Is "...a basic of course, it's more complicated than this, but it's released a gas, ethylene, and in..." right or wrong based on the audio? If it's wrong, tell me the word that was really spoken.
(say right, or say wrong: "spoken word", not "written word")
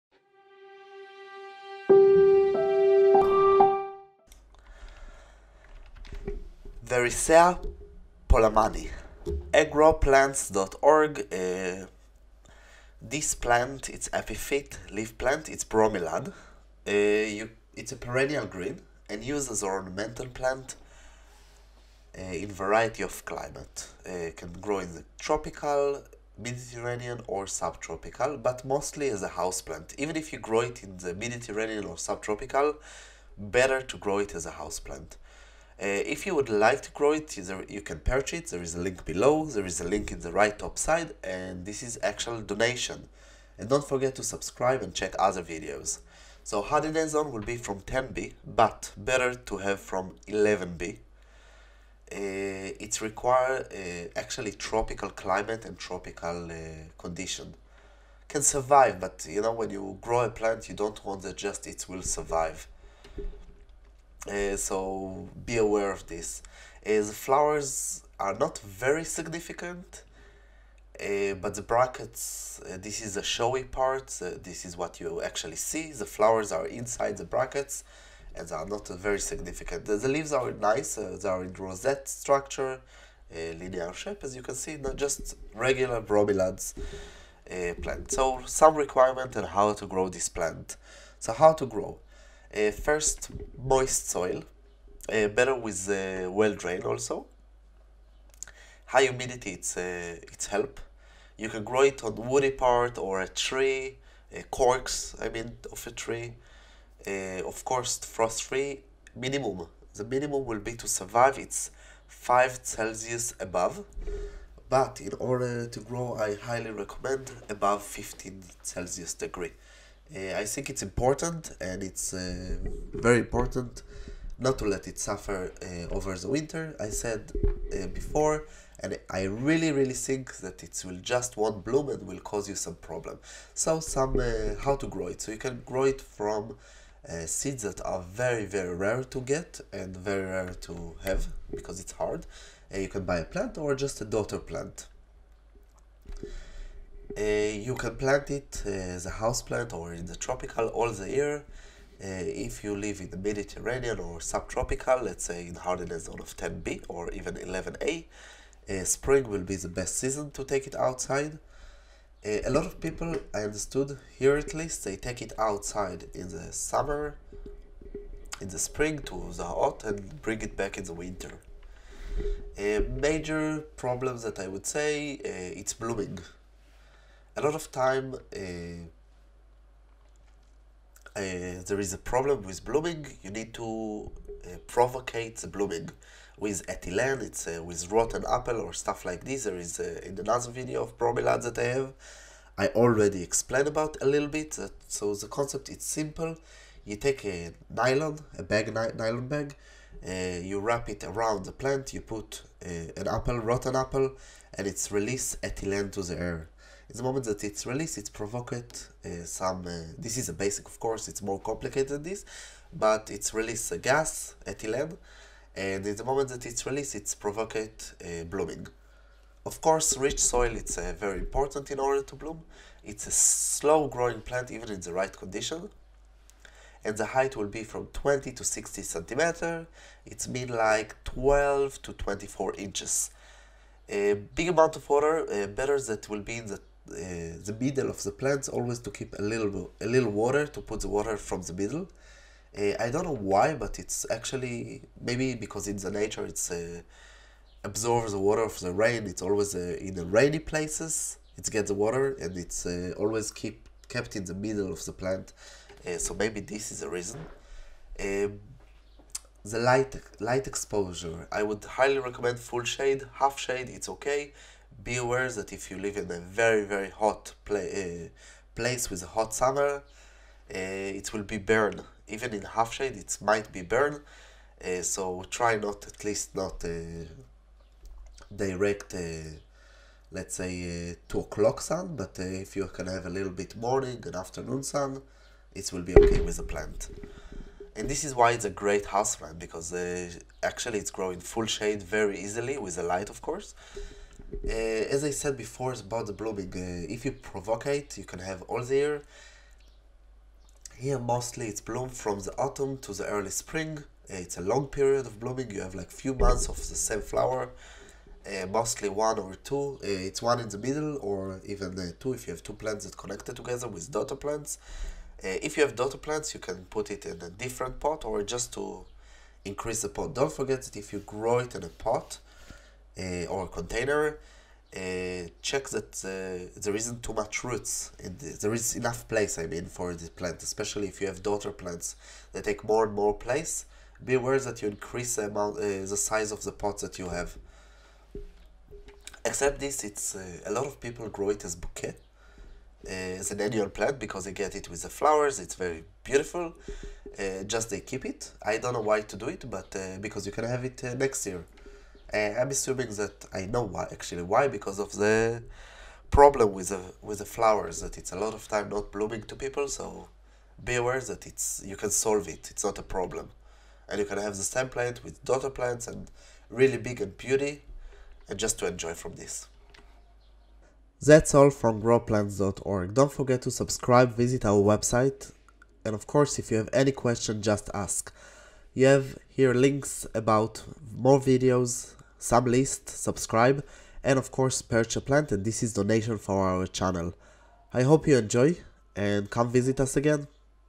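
right.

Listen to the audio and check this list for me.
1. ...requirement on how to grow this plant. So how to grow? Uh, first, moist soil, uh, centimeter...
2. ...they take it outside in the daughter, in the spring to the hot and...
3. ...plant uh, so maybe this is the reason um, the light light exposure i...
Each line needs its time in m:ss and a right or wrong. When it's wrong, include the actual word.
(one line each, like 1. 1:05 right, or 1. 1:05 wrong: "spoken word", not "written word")
1. 1:28 wrong: "better", not "centimeter"
2. 2:44 wrong: "summer", not "daughter"
3. 4:14 right.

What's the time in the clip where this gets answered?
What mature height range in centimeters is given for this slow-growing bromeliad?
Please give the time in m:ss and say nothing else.
3:47.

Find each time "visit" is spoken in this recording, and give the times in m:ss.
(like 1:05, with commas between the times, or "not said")
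6:14, 6:29.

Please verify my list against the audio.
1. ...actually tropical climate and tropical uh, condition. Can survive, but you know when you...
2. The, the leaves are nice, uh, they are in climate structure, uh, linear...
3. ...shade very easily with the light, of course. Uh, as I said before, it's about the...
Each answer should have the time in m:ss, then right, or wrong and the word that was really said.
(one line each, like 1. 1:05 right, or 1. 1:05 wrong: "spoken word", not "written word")
1. 0:54 right
2. 1:19 wrong: "rosette", not "climate"
3. 4:51 right.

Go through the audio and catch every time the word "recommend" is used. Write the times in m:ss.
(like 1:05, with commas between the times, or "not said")
1:56, 4:21.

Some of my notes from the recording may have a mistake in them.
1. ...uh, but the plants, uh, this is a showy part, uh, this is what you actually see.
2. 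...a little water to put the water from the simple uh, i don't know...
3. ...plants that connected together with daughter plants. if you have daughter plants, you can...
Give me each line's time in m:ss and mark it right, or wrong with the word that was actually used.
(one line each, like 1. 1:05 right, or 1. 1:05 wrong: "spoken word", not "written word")
1. 1:11 wrong: "brackets", not "plants"
2. 3:59 wrong: "middle", not "simple"
3. 5:12 right.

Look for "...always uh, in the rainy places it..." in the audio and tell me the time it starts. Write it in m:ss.
4:09.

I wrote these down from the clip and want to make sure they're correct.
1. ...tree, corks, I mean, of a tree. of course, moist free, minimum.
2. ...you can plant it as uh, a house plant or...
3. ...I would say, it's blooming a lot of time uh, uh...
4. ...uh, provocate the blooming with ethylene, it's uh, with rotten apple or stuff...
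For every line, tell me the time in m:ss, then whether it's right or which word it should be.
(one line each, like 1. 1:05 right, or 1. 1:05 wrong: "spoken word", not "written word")
1. 1:43 wrong: "frost", not "moist"
2. 2:27 right
3. 2:54 right
4. 3:04 right.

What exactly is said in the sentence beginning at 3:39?
Of course, rich soil is uh, very important in order to bloom.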